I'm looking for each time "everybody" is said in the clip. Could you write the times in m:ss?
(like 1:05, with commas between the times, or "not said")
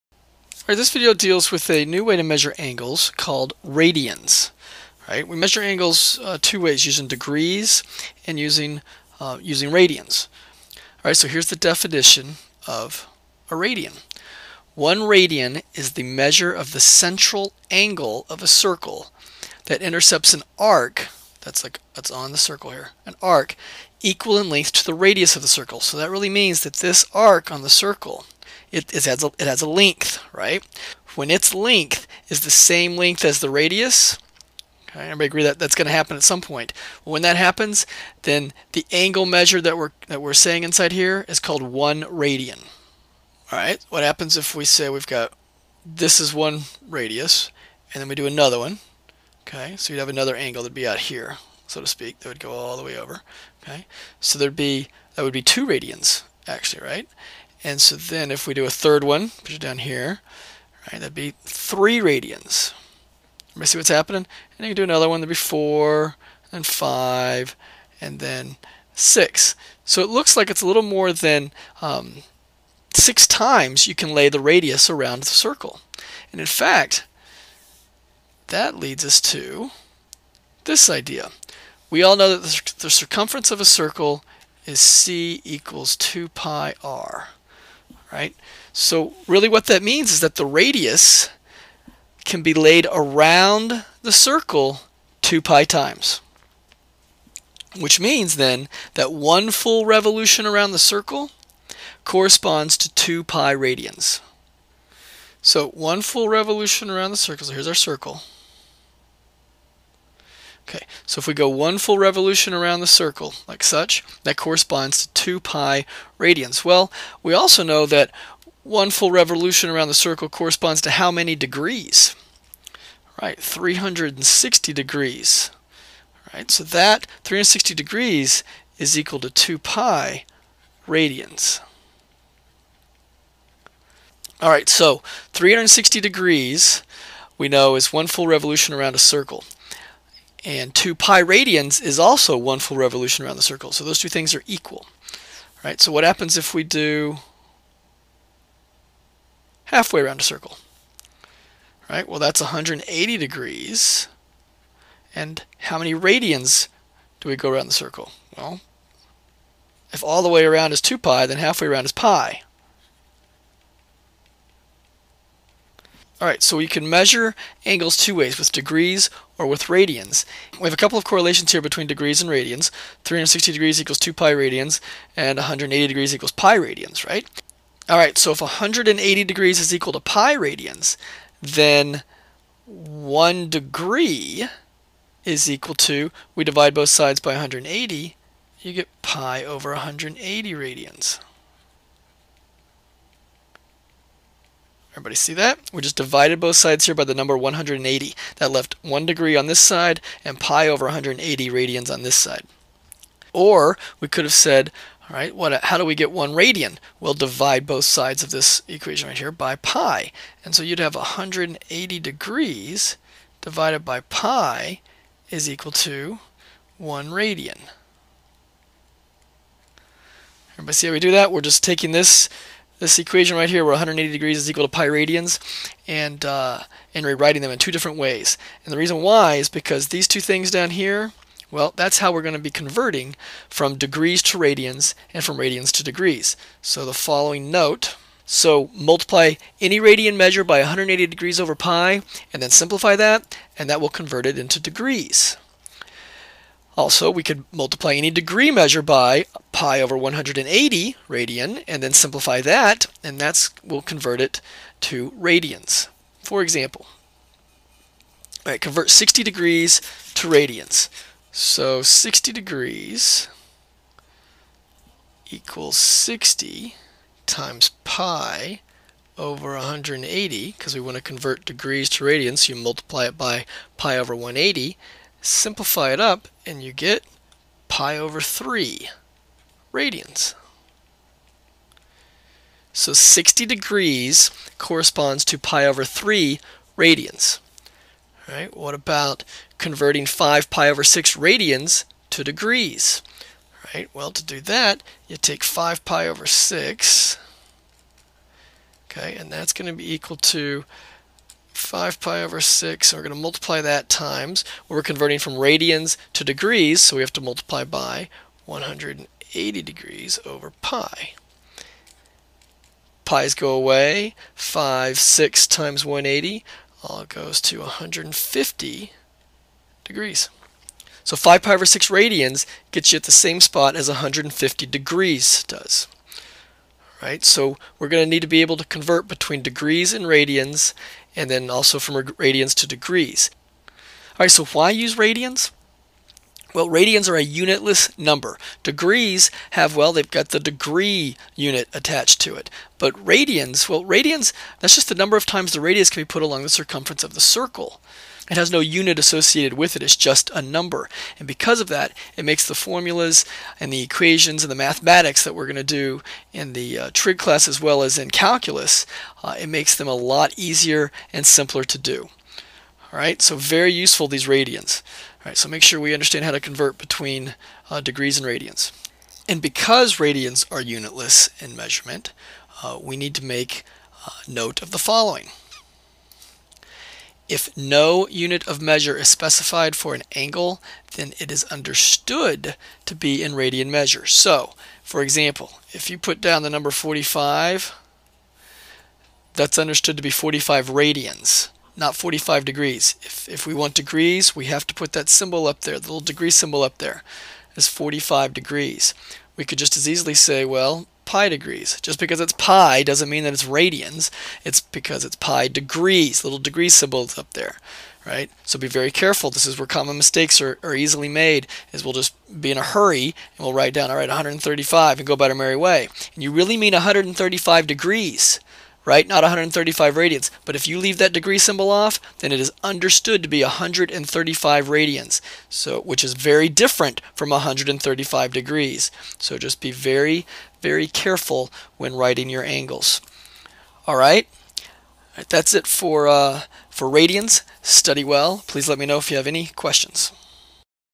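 0:35, 1:03, 3:14, 3:40.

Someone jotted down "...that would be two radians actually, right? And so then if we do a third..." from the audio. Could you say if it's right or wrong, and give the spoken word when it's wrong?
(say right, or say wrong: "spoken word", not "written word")
right.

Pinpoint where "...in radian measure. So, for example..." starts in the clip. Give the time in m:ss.
6:23.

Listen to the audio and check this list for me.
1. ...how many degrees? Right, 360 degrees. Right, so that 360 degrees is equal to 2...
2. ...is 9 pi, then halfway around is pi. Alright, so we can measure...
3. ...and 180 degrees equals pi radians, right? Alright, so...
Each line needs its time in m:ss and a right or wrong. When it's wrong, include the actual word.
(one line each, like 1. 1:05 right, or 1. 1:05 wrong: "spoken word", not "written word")
1. 2:00 right
2. 2:40 wrong: "2", not "9"
3. 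2:55 right.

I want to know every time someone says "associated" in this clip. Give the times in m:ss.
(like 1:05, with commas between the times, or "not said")
5:48.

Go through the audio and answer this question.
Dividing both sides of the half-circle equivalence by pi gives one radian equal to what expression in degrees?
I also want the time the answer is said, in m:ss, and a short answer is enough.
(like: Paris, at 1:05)
180 degrees/pi, at 3:30.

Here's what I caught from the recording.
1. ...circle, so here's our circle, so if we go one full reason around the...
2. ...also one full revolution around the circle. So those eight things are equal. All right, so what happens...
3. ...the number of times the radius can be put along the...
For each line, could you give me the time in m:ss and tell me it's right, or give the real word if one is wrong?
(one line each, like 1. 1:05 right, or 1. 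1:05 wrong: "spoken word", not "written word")
1. 1:47 wrong: "revolution", not "reason"
2. 2:21 wrong: "two", not "eight"
3. 5:44 right.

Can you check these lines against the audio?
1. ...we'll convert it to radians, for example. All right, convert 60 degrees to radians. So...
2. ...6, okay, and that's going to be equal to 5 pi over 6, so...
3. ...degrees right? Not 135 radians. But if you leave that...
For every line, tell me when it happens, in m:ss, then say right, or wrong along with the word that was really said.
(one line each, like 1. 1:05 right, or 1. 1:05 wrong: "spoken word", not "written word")
1. 4:13 right
2. 4:56 right
3. 6:57 right.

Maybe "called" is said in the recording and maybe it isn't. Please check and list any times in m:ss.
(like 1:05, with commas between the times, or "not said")
0:03, 0:41.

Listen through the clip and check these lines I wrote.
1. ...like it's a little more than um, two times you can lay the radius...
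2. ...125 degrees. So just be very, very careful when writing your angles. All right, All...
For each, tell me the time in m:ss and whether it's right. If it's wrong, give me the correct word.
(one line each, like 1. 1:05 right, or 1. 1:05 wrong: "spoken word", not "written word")
1. 1:10 wrong: "six", not "two"
2. 7:07 wrong: "135", not "125".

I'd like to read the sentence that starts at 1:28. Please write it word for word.
So really what that means is that the radius can be laid around the circle 2 pi times.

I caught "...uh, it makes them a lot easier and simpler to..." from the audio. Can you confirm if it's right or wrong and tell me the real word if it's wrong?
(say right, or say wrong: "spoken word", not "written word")
right.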